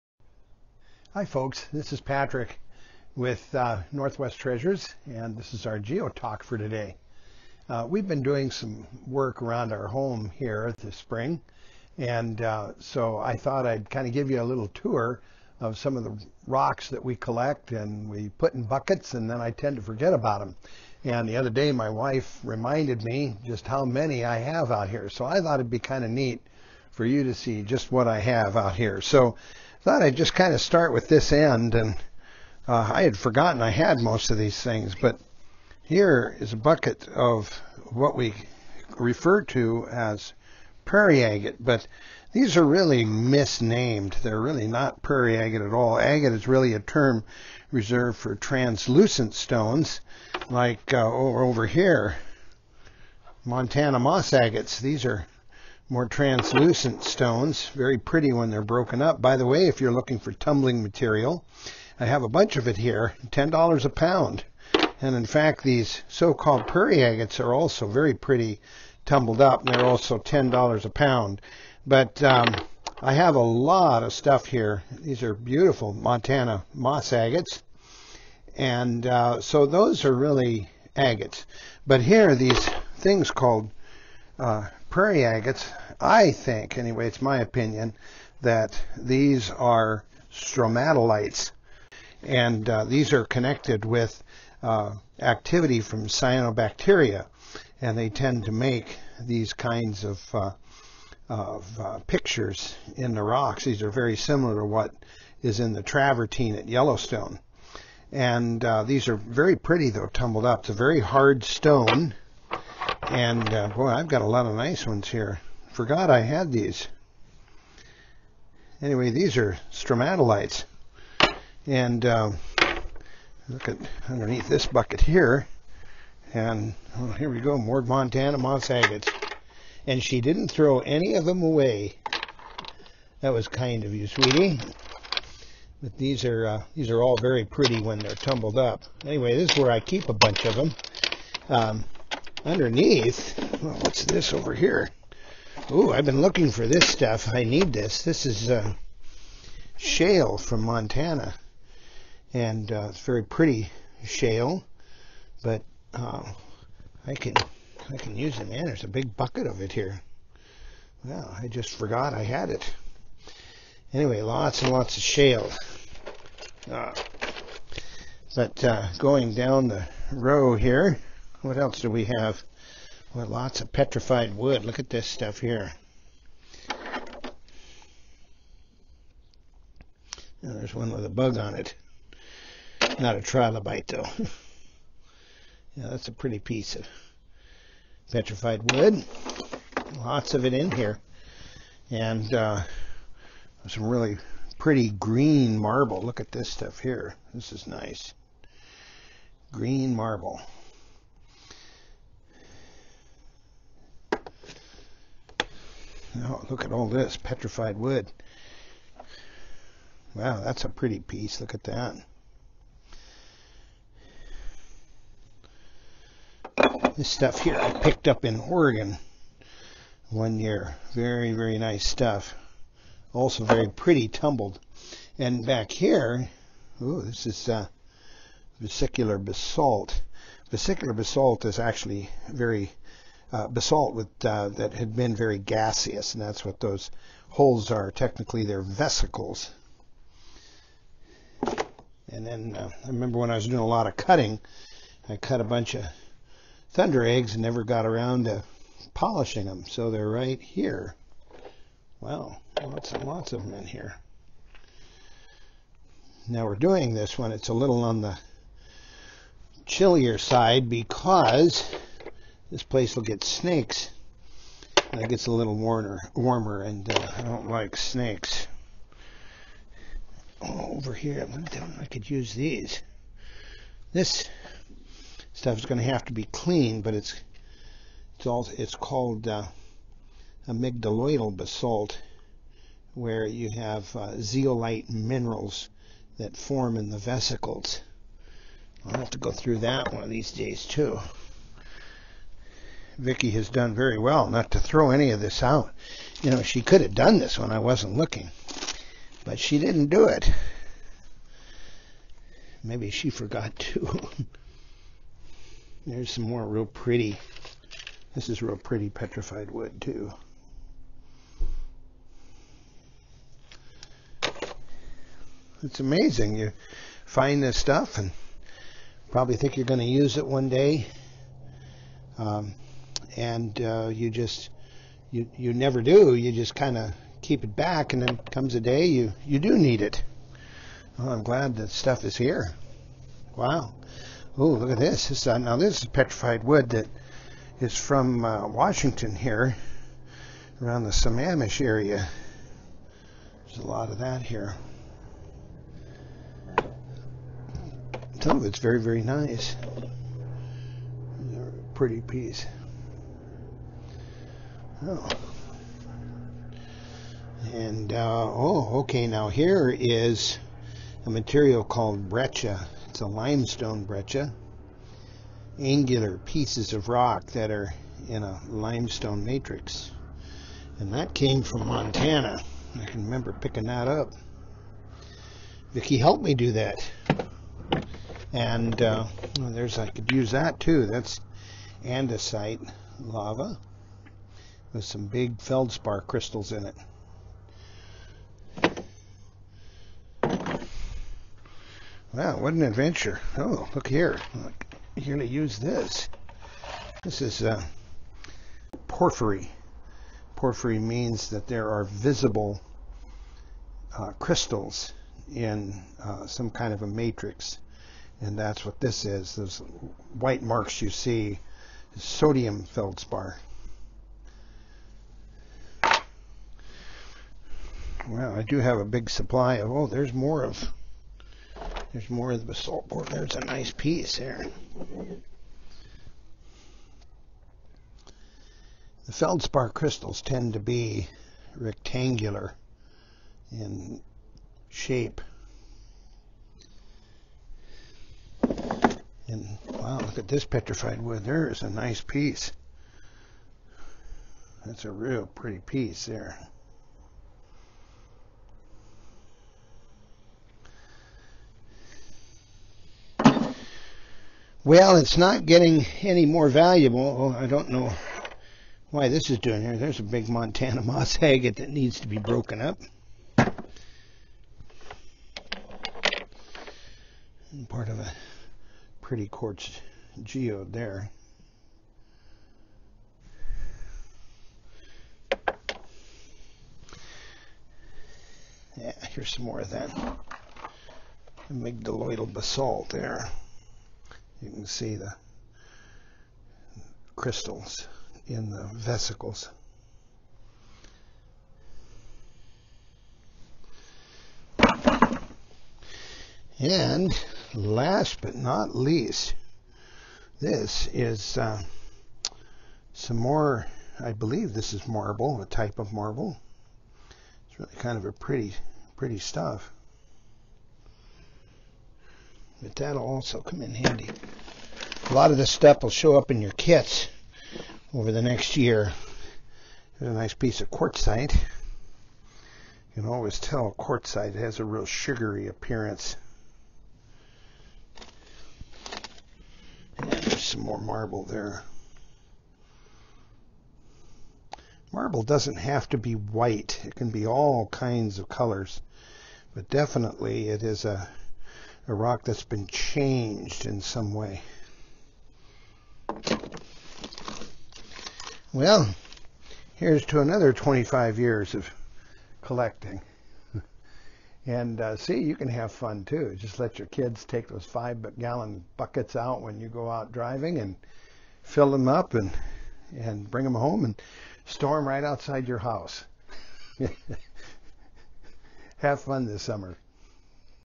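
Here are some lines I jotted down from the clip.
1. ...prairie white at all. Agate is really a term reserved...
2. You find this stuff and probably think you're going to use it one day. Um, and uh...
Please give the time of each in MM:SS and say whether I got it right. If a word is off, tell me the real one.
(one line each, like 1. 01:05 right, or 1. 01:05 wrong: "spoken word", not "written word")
1. 00:45 wrong: "agate", not "white"
2. 05:16 right.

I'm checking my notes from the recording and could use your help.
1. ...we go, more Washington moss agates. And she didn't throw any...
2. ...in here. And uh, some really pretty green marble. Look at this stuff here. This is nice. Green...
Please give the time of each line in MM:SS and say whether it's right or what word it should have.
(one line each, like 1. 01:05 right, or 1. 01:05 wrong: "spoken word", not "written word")
1. 02:07 wrong: "Montana", not "Washington"
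2. 03:10 right.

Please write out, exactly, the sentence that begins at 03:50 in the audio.
Vesicular basalt is actually very uh, basalt with, uh, that had been very gaseous, and that's what those holes are.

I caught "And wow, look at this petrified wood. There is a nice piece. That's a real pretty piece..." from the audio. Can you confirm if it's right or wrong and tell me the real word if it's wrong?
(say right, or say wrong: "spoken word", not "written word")
right.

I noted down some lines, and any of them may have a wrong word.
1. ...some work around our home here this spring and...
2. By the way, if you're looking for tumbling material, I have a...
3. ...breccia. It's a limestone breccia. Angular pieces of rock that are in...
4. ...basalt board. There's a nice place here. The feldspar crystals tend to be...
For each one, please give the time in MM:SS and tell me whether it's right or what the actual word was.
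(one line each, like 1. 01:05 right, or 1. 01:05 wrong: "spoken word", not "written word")
1. 00:08 right
2. 00:59 right
3. 06:02 right
4. 07:02 wrong: "piece", not "place".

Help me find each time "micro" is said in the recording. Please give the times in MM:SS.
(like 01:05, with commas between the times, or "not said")
not said.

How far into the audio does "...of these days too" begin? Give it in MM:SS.
04:50.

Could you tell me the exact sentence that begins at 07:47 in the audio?
And part of a pretty quartz geode there.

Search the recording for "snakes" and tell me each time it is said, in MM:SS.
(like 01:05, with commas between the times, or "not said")
04:23, 04:27.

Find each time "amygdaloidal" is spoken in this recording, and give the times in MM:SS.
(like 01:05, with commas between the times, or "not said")
04:40, 08:01.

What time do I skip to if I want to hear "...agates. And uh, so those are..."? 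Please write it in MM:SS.
01:17.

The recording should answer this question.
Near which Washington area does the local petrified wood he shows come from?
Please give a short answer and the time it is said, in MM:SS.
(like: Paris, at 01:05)
Sammamish, at 05:40.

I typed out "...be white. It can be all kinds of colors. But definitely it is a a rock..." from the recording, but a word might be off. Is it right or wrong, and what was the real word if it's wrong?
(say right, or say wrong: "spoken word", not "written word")
right.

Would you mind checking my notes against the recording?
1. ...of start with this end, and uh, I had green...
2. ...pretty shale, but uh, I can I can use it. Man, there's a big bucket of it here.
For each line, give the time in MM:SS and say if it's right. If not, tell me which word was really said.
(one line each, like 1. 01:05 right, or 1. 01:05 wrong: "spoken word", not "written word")
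1. 00:30 wrong: "forgotten", not "green"
2. 02:33 right.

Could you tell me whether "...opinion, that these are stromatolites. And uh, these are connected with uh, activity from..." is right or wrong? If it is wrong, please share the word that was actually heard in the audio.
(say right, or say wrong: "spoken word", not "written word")
right.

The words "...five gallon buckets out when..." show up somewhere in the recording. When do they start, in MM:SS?
09:17.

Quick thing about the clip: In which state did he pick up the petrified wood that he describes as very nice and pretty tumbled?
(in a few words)
Oregon.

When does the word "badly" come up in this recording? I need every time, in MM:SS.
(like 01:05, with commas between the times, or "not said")
not said.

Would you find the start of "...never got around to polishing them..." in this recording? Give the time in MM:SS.
04:07.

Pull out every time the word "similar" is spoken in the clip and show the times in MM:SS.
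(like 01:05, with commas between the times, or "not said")
01:44.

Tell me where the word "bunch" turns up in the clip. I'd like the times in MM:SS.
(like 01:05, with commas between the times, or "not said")
01:02, 02:20, 04:05.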